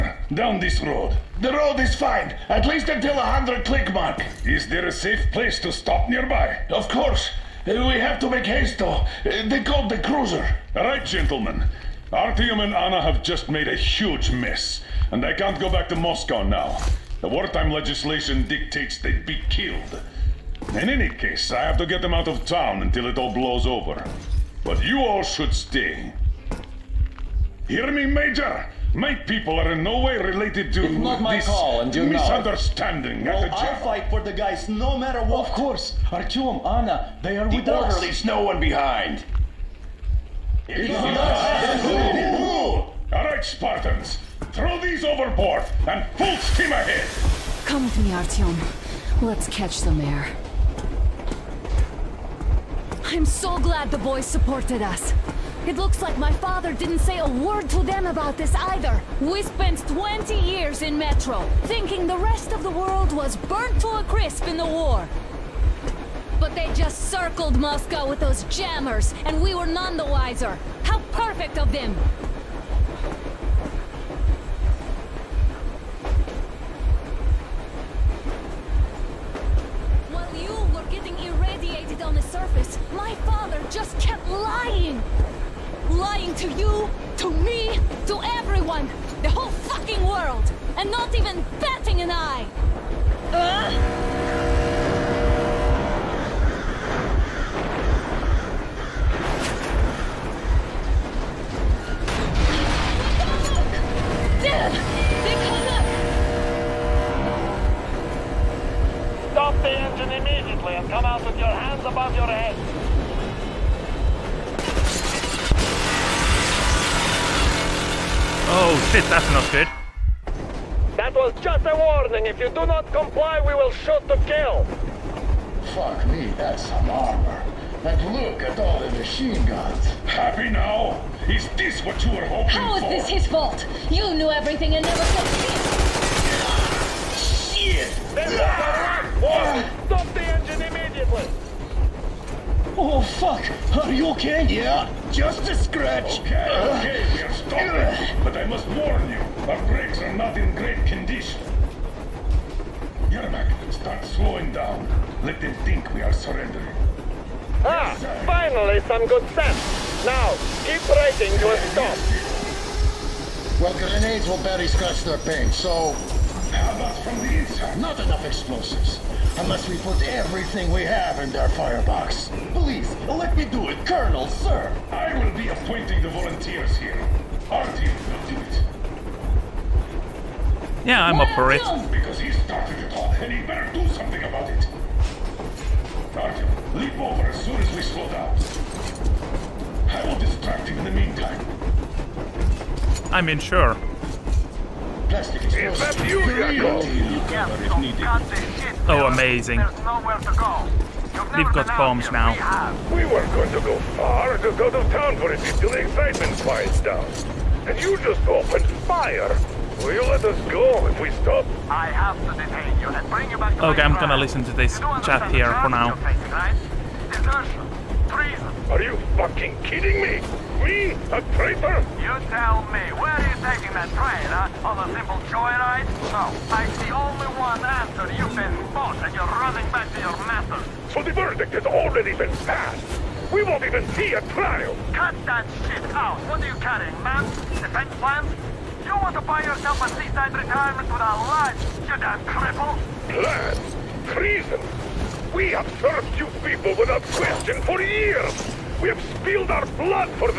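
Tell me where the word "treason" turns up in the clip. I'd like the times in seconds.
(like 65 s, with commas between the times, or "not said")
218 s, 244 s.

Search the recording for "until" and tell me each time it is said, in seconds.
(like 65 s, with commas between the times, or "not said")
2 s, 22 s, 205 s.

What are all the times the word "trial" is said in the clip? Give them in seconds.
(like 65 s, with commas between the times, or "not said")
234 s.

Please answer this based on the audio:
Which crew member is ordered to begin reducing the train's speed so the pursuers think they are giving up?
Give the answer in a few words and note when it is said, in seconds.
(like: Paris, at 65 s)
Yermak, at 153 s.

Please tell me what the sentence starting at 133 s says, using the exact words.
You knew everything and never said shit!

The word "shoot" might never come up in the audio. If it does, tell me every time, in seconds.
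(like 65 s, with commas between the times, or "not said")
123 s.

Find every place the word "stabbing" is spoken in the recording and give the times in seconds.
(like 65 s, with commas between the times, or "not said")
not said.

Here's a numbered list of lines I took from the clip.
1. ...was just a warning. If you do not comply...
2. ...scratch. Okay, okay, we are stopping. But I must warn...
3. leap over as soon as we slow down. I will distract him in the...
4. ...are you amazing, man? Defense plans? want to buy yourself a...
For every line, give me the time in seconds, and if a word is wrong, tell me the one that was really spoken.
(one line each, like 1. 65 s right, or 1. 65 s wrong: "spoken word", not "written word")
1. 121 s right
2. 145 s right
3. 186 s right
4. 236 s wrong: "carrying", not "amazing".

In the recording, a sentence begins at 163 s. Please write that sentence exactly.
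Well, grenades will barely scratch their paint, so...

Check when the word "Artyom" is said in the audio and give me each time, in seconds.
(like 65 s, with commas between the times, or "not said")
12 s, 36 s, 48 s.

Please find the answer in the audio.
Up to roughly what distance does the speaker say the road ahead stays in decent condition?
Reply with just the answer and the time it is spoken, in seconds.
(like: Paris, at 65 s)
100 clicks, at 3 s.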